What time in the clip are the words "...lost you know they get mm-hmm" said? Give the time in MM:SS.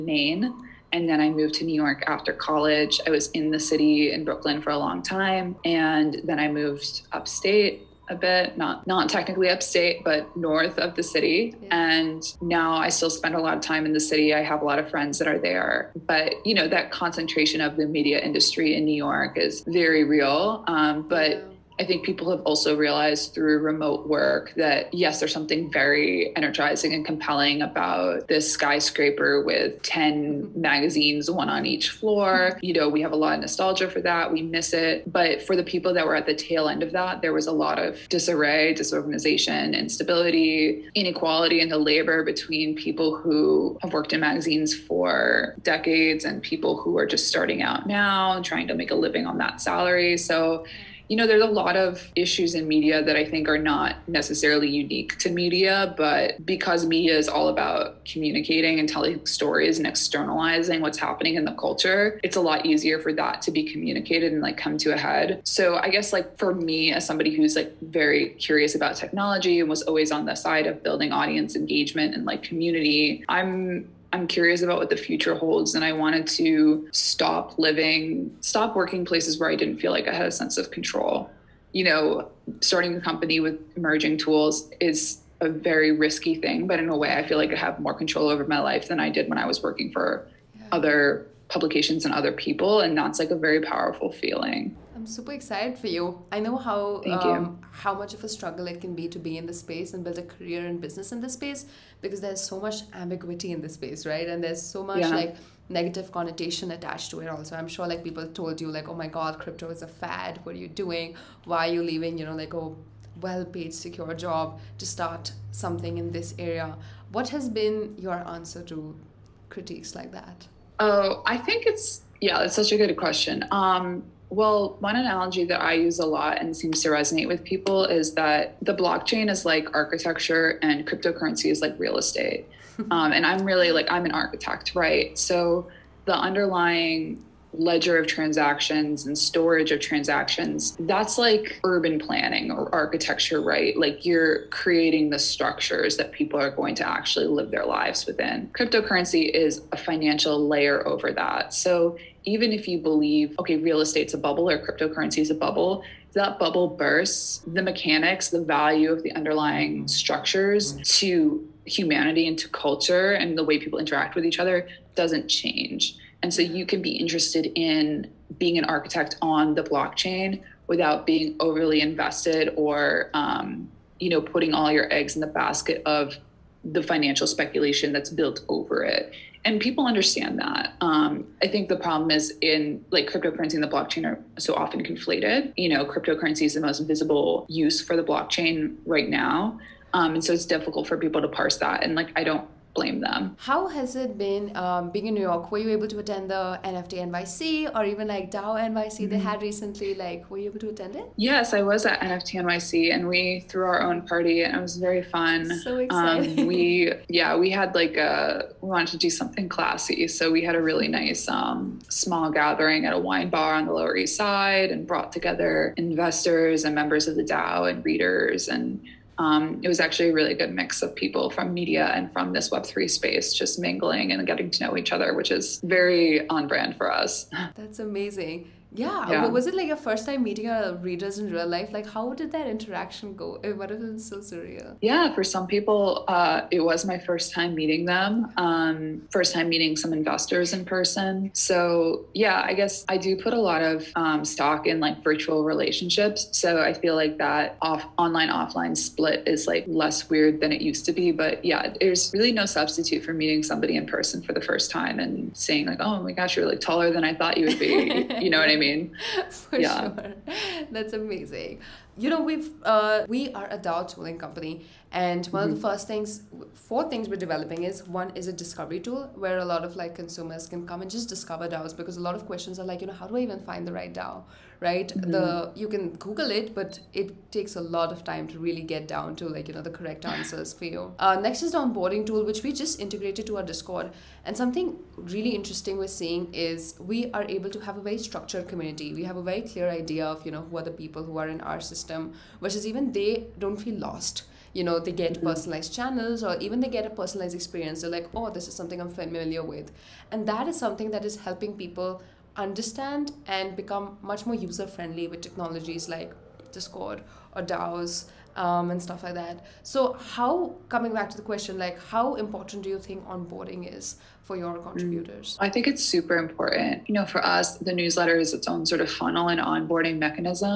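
04:53.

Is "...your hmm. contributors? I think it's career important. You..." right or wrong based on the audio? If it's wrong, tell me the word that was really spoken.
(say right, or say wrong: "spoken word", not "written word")
wrong: "super", not "career".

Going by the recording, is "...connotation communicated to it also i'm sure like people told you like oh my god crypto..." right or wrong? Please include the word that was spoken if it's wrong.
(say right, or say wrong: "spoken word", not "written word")
wrong: "attached", not "communicated".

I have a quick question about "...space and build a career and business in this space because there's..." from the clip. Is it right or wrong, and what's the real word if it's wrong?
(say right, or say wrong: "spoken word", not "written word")
right.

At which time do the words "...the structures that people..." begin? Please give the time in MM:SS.
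02:25.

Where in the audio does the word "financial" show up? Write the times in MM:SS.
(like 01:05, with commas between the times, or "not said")
02:29, 02:56.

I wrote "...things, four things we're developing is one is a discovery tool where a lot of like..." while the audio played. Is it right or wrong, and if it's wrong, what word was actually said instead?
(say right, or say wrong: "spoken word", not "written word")
right.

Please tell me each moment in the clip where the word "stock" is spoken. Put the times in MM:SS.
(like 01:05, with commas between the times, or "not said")
04:04.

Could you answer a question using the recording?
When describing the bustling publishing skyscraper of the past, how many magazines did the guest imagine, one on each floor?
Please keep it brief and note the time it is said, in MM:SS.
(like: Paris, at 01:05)
10, at 00:29.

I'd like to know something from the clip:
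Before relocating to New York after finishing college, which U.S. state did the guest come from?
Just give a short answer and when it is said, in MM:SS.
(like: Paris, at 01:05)
Maine, at 00:00.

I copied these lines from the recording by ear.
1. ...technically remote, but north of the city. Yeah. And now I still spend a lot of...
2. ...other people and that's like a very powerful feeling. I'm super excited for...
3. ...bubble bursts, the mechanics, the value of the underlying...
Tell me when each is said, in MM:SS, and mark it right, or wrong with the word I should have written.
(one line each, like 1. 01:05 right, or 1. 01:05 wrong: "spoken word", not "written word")
1. 00:09 wrong: "upstate", not "remote"
2. 01:32 right
3. 02:36 right.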